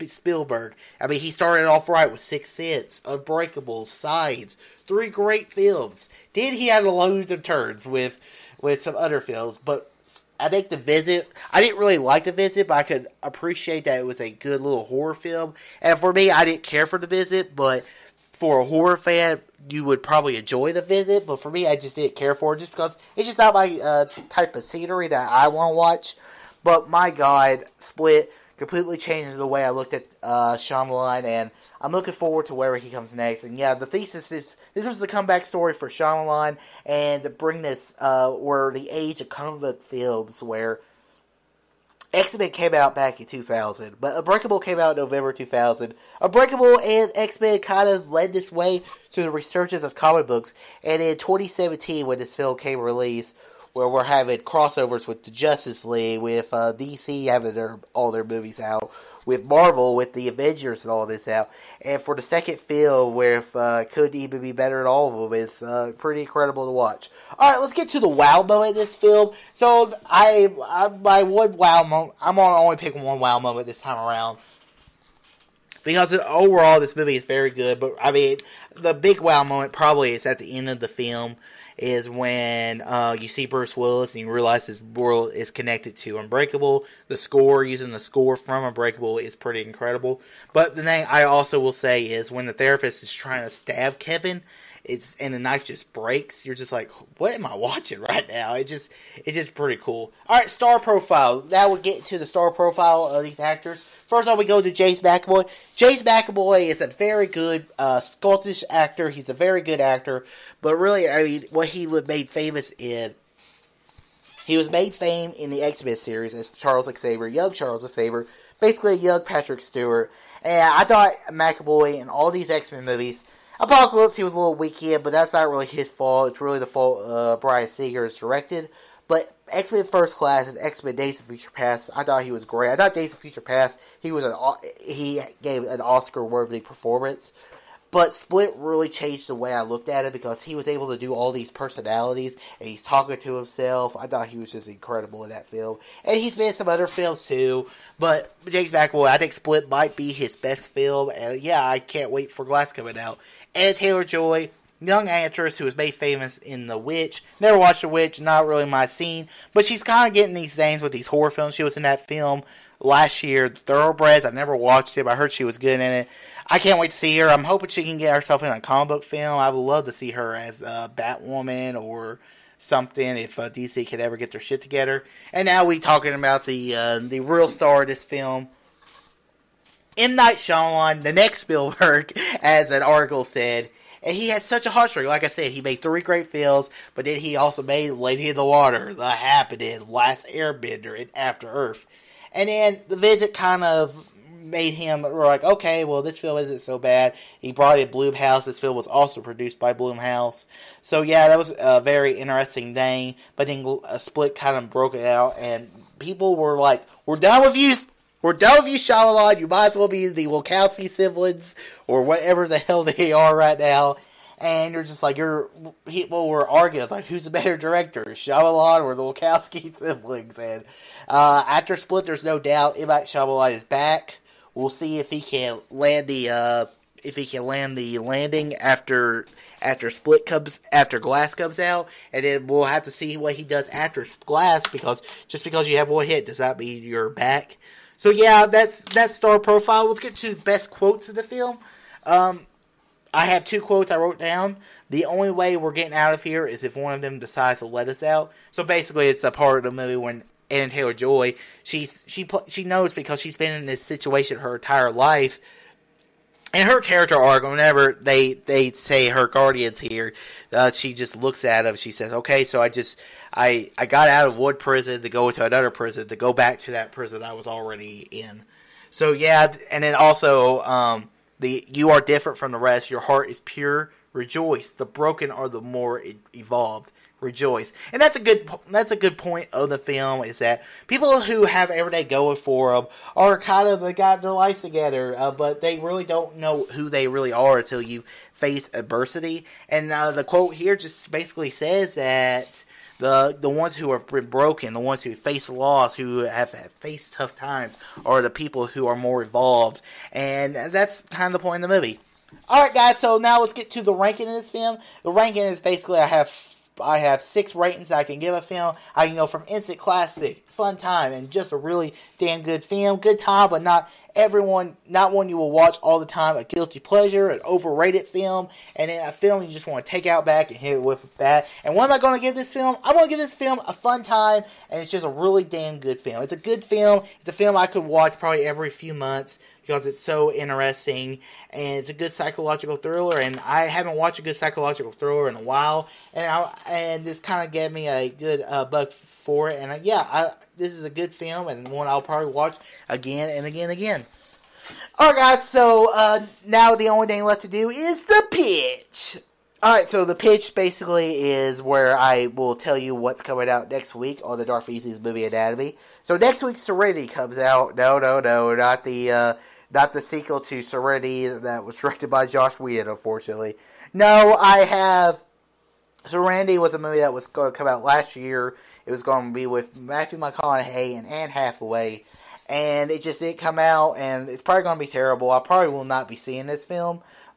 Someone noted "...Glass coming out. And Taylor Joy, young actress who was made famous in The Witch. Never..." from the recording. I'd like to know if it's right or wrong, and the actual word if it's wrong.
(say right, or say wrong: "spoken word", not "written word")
right.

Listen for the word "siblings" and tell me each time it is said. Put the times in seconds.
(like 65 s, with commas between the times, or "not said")
210 s, 219 s.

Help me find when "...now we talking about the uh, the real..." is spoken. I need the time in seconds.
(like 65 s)
175 s.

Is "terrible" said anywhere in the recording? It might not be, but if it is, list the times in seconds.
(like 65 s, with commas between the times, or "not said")
374 s.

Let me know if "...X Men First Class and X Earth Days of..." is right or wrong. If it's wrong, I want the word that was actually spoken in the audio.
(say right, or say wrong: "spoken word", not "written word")
wrong: "Men", not "Earth".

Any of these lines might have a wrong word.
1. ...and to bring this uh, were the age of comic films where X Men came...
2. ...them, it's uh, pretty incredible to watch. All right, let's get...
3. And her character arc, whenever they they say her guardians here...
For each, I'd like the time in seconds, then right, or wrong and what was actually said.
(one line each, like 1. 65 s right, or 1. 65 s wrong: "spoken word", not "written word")
1. 36 s right
2. 65 s right
3. 256 s right.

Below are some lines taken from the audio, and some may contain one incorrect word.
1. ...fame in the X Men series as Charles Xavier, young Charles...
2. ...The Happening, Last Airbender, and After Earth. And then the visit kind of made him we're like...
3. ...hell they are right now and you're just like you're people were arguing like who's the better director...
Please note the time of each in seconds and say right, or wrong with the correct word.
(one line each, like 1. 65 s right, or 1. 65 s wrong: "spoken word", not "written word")
1. 114 s right
2. 188 s right
3. 212 s right.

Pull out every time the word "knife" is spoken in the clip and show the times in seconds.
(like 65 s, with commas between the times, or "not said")
95 s.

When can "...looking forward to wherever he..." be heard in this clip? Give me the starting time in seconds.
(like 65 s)
31 s.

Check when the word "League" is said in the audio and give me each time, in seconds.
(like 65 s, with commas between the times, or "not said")
55 s.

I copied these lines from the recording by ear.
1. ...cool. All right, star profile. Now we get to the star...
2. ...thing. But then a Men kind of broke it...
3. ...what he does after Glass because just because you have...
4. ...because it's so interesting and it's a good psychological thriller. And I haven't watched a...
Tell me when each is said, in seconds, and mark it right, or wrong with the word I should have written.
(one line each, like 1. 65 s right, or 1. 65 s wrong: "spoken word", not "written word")
1. 99 s right
2. 202 s wrong: "Split", not "Men"
3. 233 s right
4. 329 s right.